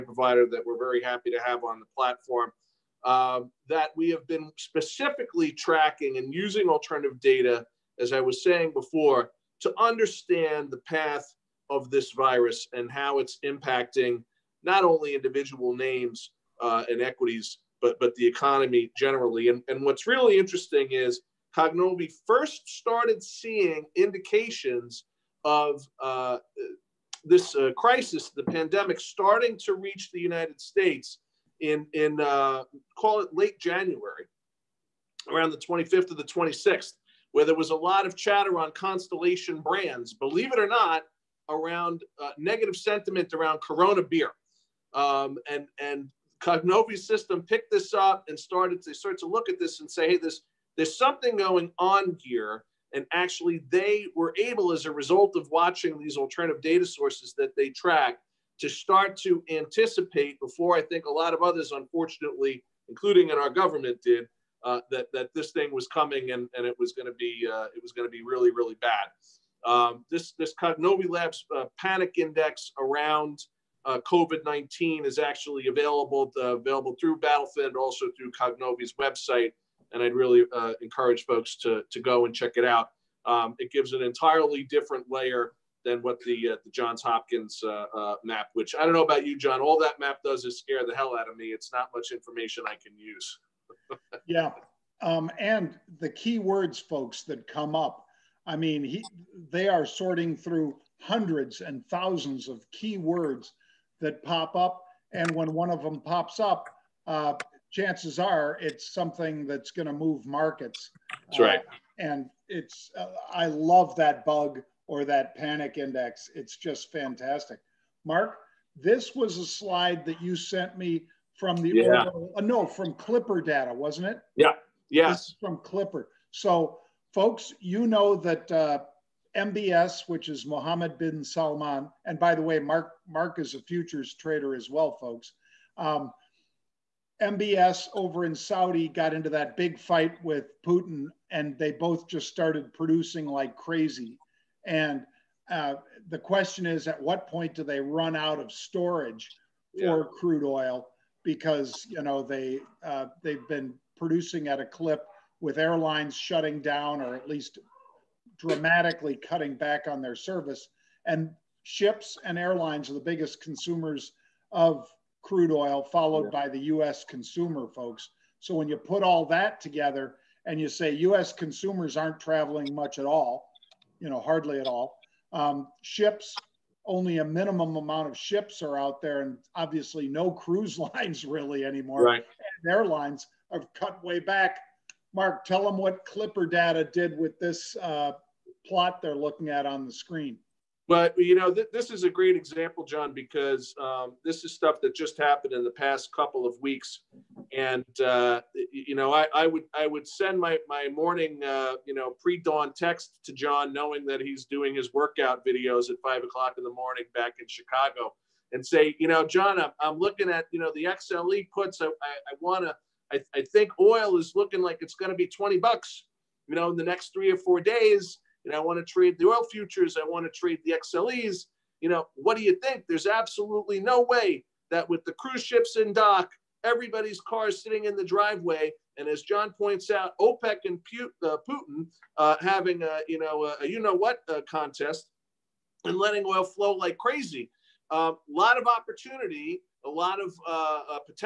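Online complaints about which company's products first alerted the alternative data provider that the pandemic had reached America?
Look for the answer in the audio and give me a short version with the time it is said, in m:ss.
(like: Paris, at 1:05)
Constellation Brands, at 0:38.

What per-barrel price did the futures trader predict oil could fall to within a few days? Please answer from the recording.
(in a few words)
$20.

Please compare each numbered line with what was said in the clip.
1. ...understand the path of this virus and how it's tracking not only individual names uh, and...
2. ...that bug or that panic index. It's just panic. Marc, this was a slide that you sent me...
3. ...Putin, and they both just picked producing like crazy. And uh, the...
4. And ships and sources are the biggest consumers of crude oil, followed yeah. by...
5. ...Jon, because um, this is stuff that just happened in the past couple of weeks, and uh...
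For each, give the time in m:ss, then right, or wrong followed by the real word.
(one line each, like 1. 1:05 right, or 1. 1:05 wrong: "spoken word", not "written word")
1. 0:09 wrong: "impacting", not "tracking"
2. 1:53 wrong: "fantastic", not "panic"
3. 2:20 wrong: "started", not "picked"
4. 2:41 wrong: "airlines", not "sources"
5. 3:12 right.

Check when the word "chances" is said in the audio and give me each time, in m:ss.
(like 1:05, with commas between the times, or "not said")
1:47.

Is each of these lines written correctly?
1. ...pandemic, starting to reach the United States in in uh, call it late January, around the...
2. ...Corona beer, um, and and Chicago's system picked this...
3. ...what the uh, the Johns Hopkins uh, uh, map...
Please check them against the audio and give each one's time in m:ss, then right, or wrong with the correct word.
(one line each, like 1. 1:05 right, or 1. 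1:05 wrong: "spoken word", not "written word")
1. 0:28 right
2. 0:43 wrong: "Cognovi", not "Chicago"
3. 1:26 right.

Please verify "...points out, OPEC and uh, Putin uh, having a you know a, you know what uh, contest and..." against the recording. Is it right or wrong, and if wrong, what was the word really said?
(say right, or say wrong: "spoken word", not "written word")
right.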